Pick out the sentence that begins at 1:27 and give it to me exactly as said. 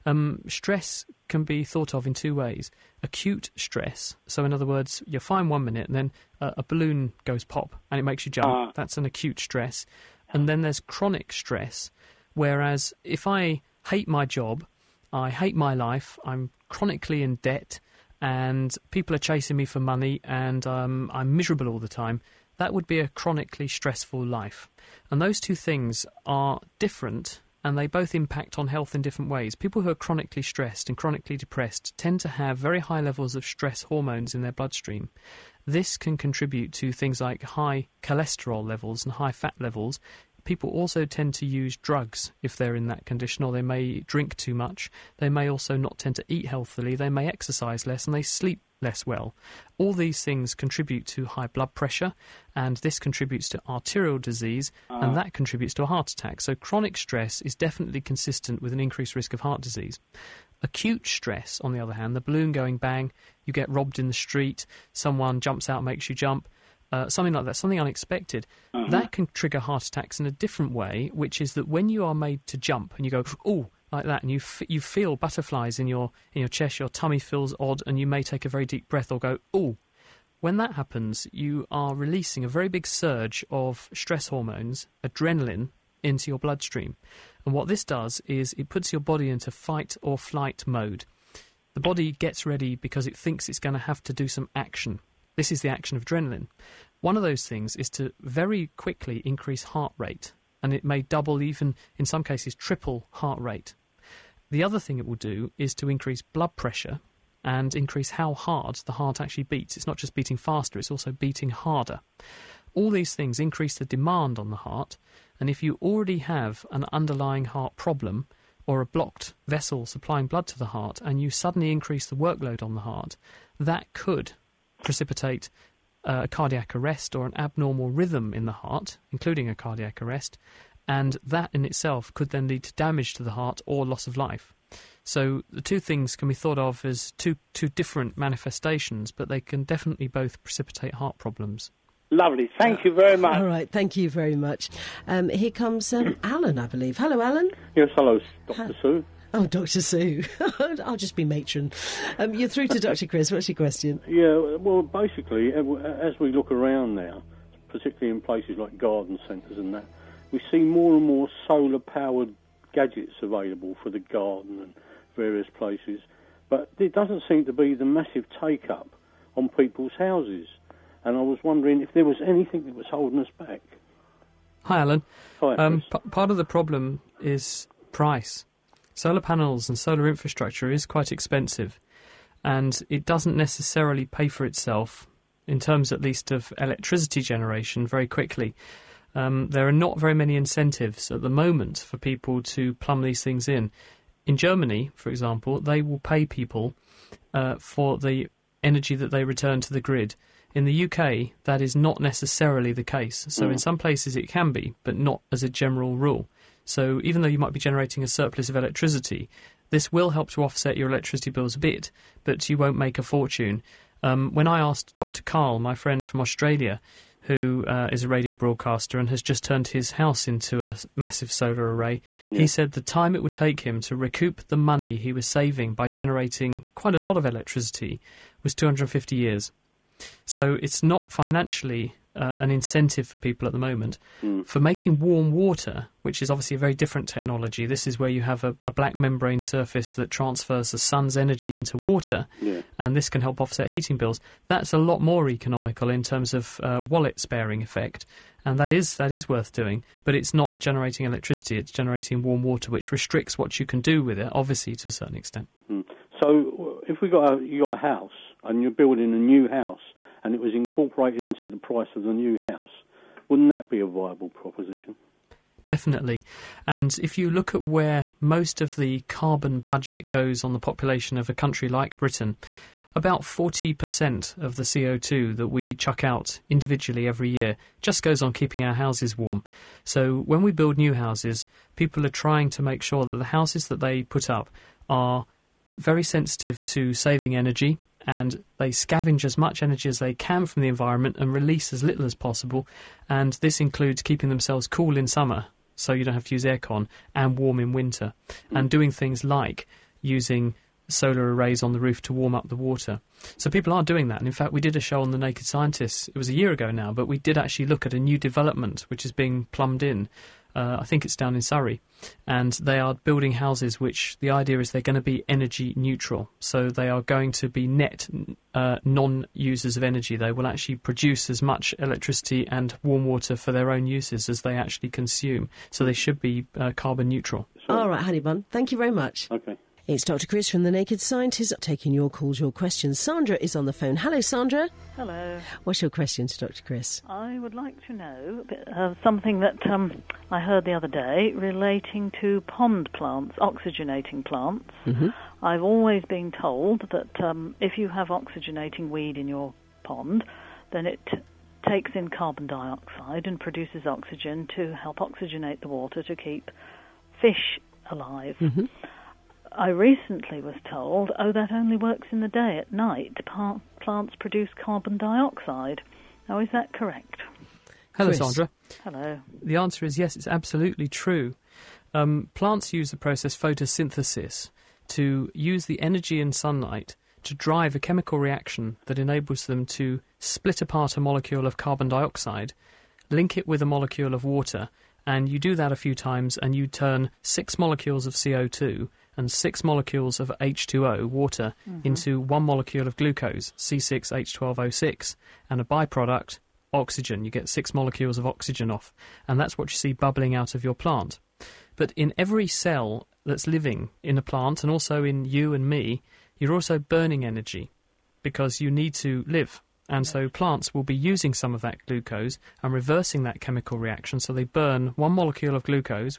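And what this does is it puts your body into fight or flight mode.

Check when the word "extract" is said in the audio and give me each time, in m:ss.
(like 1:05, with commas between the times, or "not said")
not said.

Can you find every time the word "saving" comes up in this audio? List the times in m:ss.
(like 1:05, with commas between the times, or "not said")
3:45, 4:46.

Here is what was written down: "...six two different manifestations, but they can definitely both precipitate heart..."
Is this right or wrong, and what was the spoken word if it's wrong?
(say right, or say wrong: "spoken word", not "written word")
wrong: "two", not "six".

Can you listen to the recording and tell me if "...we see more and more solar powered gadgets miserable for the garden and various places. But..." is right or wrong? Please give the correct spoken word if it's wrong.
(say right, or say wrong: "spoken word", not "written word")
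wrong: "available", not "miserable".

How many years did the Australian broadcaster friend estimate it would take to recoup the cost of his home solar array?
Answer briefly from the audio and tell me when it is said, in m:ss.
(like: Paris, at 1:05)
250, at 3:48.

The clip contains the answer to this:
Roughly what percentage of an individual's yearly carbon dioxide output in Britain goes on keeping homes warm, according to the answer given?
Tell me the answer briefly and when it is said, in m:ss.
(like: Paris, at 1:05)
40%, at 4:32.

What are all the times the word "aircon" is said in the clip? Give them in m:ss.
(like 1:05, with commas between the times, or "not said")
4:56.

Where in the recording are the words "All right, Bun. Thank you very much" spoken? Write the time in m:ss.
5:27.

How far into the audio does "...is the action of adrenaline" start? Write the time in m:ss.
1:35.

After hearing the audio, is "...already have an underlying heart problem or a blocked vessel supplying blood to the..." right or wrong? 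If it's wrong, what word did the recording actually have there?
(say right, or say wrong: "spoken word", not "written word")
right.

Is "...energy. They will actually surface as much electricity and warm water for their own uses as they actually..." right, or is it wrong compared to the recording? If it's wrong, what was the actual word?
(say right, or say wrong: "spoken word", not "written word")
wrong: "produce", not "surface".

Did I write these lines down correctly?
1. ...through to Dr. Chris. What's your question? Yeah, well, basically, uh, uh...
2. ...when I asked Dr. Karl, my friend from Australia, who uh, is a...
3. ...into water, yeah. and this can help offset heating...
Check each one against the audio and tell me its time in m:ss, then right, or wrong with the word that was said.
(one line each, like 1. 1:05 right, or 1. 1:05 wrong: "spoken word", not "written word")
1. 2:32 right
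2. 3:34 right
3. 4:01 right.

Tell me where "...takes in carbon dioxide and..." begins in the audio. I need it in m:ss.
5:51.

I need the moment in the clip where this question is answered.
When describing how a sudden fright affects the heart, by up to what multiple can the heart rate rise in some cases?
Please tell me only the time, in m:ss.
1:42.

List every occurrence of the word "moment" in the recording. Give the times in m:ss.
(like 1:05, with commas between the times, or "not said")
3:11, 3:53.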